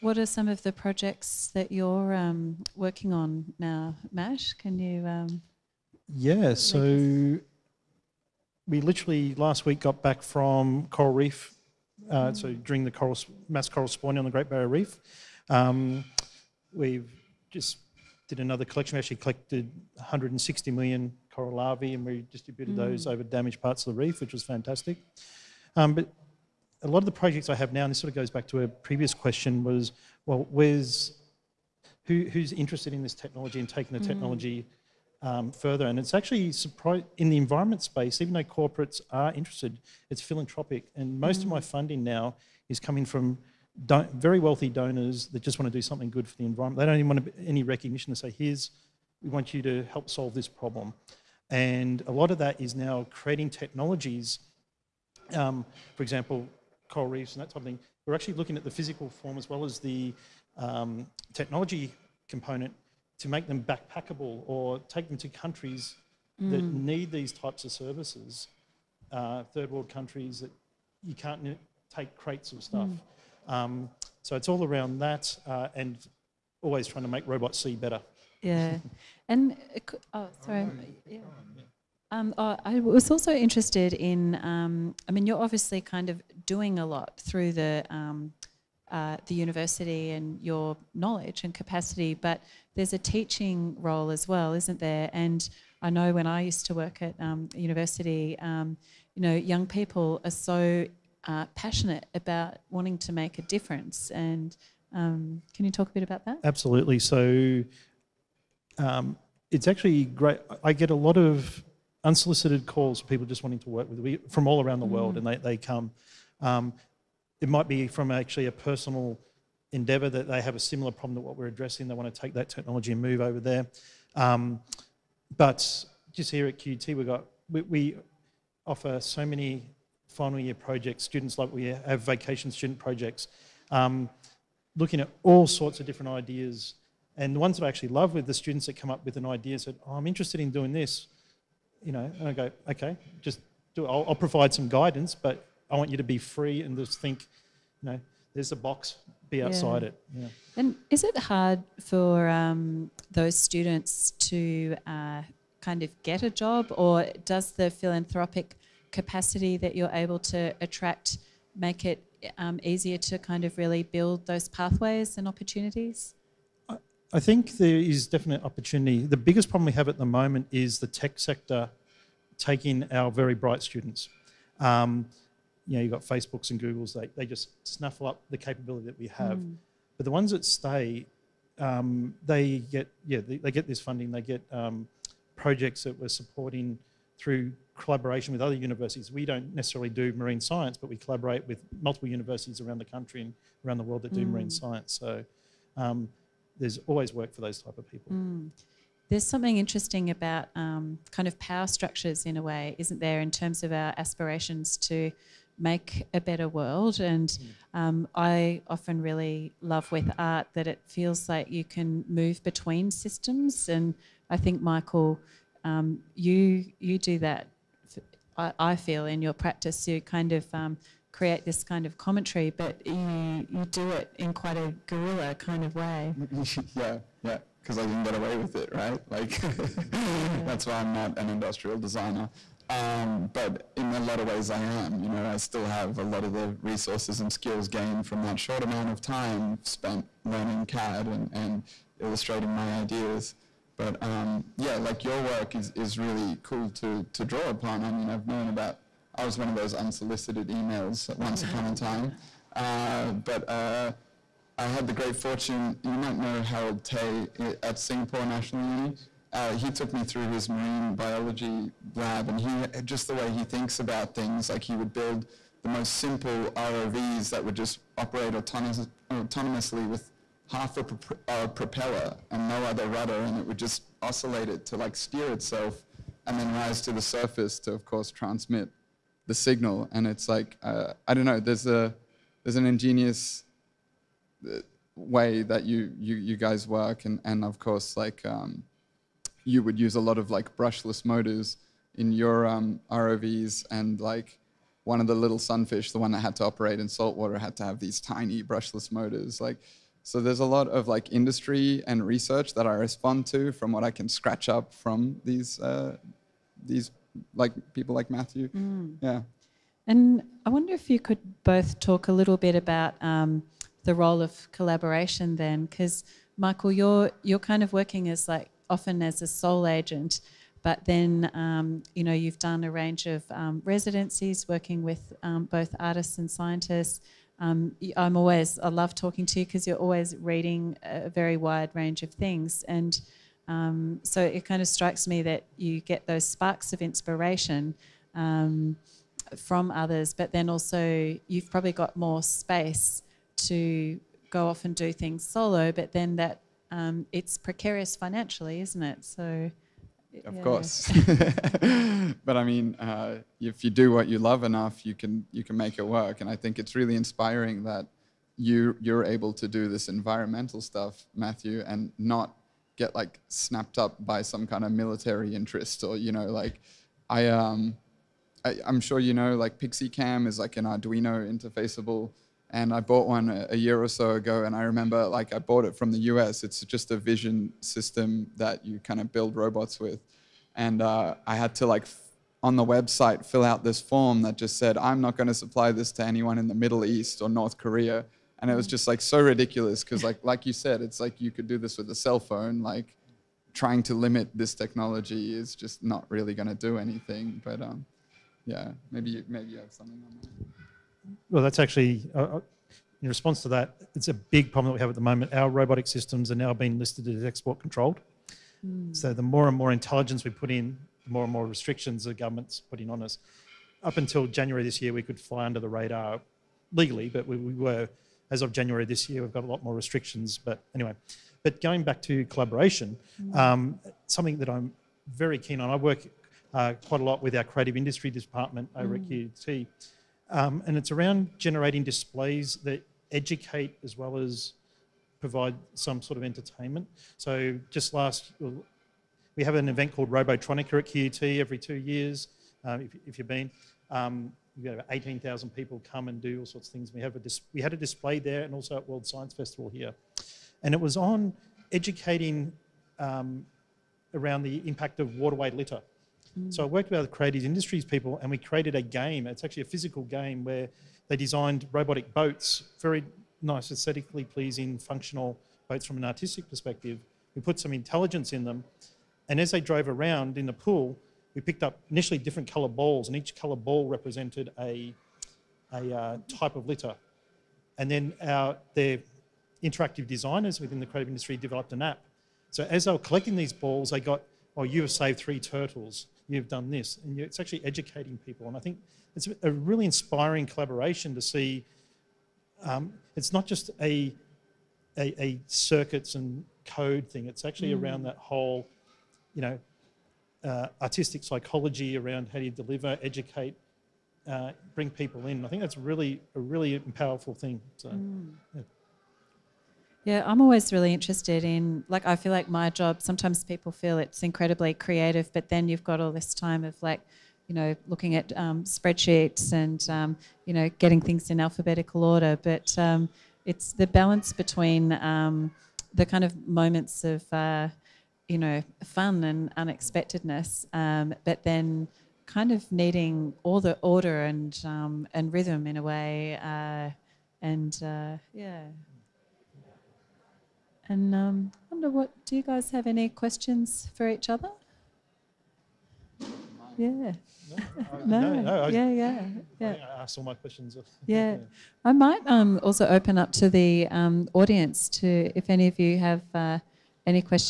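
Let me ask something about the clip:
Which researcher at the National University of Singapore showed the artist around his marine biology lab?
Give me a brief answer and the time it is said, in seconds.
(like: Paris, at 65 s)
Harold Tay, at 256 s.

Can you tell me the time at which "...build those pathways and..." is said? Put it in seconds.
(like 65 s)
163 s.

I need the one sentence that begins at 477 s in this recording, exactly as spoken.
And then our, their interactive designers within the creative industry developed an app.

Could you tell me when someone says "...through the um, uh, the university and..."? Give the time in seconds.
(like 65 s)
87 s.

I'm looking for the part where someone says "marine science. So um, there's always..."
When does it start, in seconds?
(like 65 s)
194 s.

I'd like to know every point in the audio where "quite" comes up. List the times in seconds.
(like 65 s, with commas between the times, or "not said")
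224 s, 426 s.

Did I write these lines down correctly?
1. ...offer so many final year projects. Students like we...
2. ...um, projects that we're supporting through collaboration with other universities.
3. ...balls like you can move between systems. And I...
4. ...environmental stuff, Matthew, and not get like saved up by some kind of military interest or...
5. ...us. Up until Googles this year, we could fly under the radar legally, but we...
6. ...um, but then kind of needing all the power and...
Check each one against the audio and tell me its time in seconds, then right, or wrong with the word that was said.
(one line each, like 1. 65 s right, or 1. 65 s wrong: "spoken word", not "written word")
1. 128 s right
2. 184 s right
3. 210 s wrong: "feels", not "balls"
4. 359 s wrong: "snapped", not "saved"
5. 413 s wrong: "January", not "Googles"
6. 530 s wrong: "order", not "power".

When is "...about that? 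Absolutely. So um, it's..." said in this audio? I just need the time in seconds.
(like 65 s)
106 s.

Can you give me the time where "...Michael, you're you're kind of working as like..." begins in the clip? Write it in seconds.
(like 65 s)
316 s.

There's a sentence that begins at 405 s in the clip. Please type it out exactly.
Our robotic systems are now being listed as export controlled.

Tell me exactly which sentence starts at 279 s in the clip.
And it's like uh, I don't know.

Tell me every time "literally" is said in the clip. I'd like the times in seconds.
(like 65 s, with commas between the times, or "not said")
8 s.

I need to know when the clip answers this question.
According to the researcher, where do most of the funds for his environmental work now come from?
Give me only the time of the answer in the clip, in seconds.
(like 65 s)
44 s.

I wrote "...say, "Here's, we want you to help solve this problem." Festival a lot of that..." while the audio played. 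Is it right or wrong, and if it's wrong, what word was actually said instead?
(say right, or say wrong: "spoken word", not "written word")
wrong: "And", not "Festival".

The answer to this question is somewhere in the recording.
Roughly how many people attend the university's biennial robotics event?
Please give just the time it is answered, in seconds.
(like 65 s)
444 s.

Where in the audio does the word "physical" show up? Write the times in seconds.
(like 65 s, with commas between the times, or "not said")
58 s, 459 s.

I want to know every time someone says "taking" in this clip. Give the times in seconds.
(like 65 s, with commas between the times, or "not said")
33 s, 172 s.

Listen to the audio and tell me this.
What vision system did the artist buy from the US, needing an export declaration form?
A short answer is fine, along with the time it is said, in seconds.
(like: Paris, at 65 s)
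Pixy Cam, at 369 s.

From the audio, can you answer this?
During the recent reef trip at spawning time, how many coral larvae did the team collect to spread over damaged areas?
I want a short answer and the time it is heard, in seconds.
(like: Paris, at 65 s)
160 million, at 19 s.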